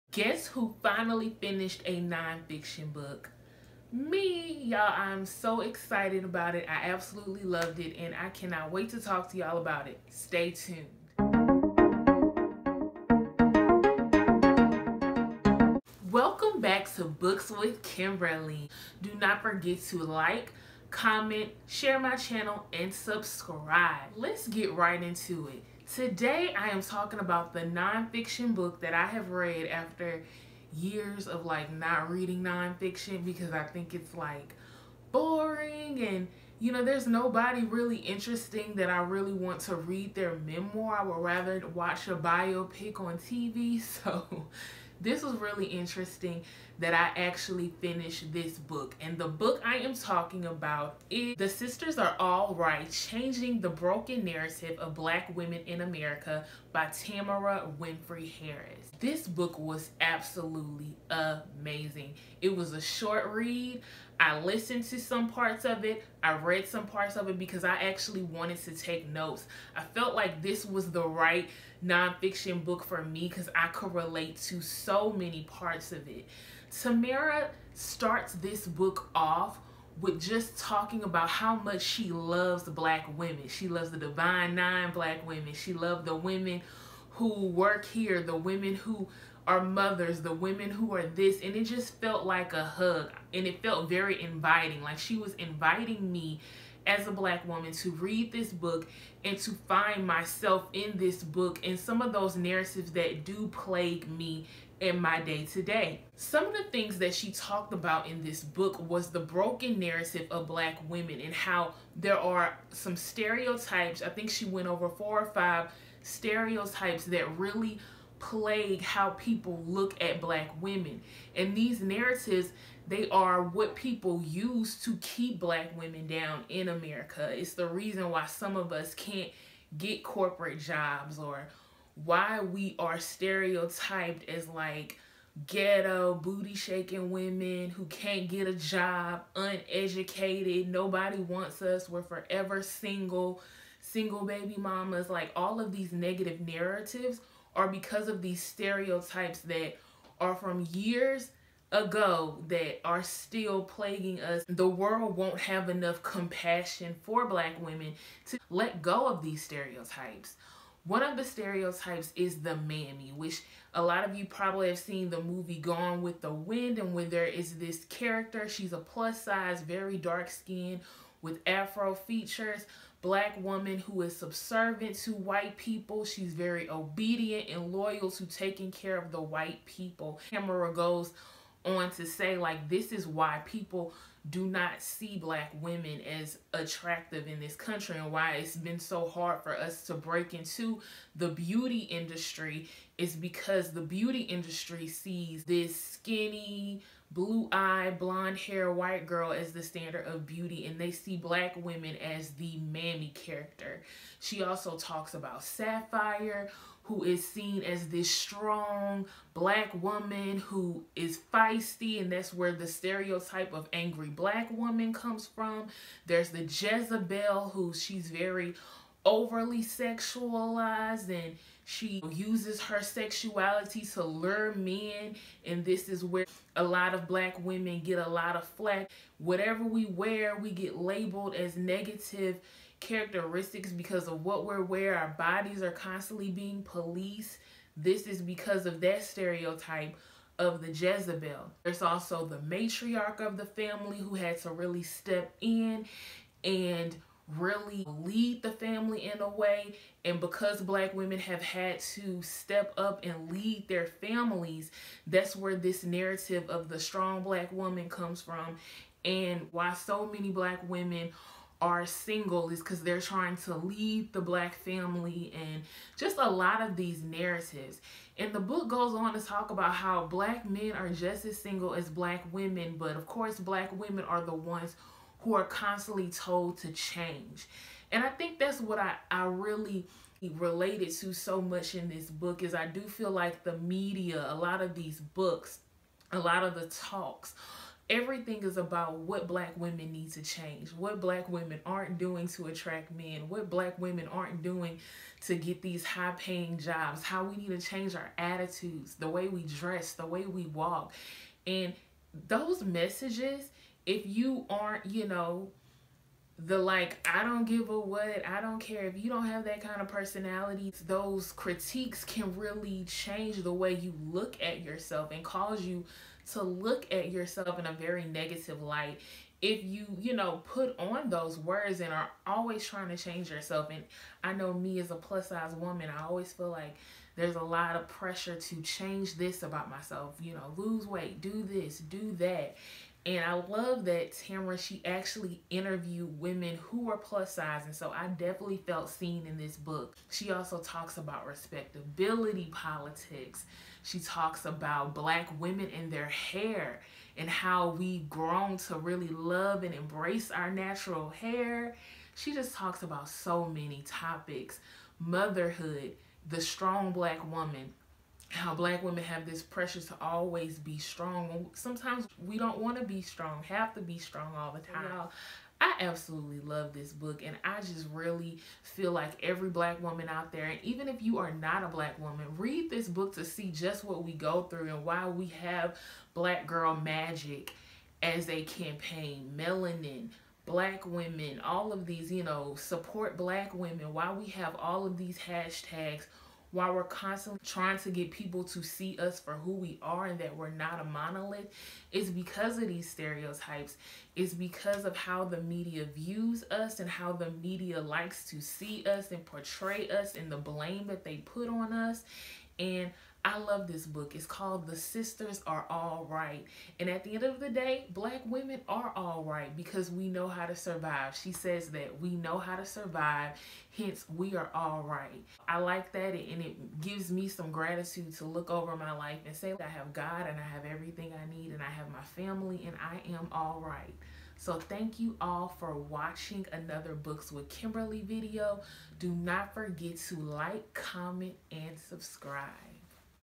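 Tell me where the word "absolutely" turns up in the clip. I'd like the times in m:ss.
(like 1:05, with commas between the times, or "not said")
0:06, 1:00, 6:05.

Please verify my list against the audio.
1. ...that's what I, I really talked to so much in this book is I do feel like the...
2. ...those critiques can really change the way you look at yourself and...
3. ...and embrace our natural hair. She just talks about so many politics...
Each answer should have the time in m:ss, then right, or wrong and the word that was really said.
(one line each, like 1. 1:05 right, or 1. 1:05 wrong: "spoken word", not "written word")
1. 4:38 wrong: "related", not "talked"
2. 5:10 right
3. 5:49 wrong: "topics", not "politics".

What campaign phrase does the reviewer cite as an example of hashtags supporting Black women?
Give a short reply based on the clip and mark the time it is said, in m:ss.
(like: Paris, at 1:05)
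Black Girl Magic, at 6:16.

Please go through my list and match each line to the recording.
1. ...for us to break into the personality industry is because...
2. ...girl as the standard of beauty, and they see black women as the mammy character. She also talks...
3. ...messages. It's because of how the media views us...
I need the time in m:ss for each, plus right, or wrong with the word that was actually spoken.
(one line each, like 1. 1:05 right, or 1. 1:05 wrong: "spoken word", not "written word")
1. 3:09 wrong: "beauty", not "personality"
2. 3:19 right
3. 6:32 wrong: "stereotypes", not "messages".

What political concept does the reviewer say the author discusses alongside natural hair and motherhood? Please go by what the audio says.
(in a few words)
respectability politics.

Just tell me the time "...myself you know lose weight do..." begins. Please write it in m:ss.
5:29.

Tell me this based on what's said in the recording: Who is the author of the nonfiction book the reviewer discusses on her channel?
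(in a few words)
Tamara Winfrey Harris.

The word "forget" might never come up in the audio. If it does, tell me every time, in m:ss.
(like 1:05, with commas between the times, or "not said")
0:19, 7:09.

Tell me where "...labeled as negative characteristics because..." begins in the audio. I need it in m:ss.
3:50.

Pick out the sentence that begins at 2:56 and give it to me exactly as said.
She's very obedient and loyal to taking care of the white people.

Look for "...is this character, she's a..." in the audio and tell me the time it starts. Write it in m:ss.
2:47.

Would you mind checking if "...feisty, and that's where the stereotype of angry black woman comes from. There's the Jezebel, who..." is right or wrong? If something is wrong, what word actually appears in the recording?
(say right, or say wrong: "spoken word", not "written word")
right.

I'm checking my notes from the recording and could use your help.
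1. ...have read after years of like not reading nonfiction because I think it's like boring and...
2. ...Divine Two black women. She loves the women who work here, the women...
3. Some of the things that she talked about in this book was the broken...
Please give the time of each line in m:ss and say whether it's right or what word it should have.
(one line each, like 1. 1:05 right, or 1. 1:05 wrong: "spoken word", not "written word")
1. 0:29 right
2. 1:23 wrong: "Nine", not "Two"
3. 1:46 right.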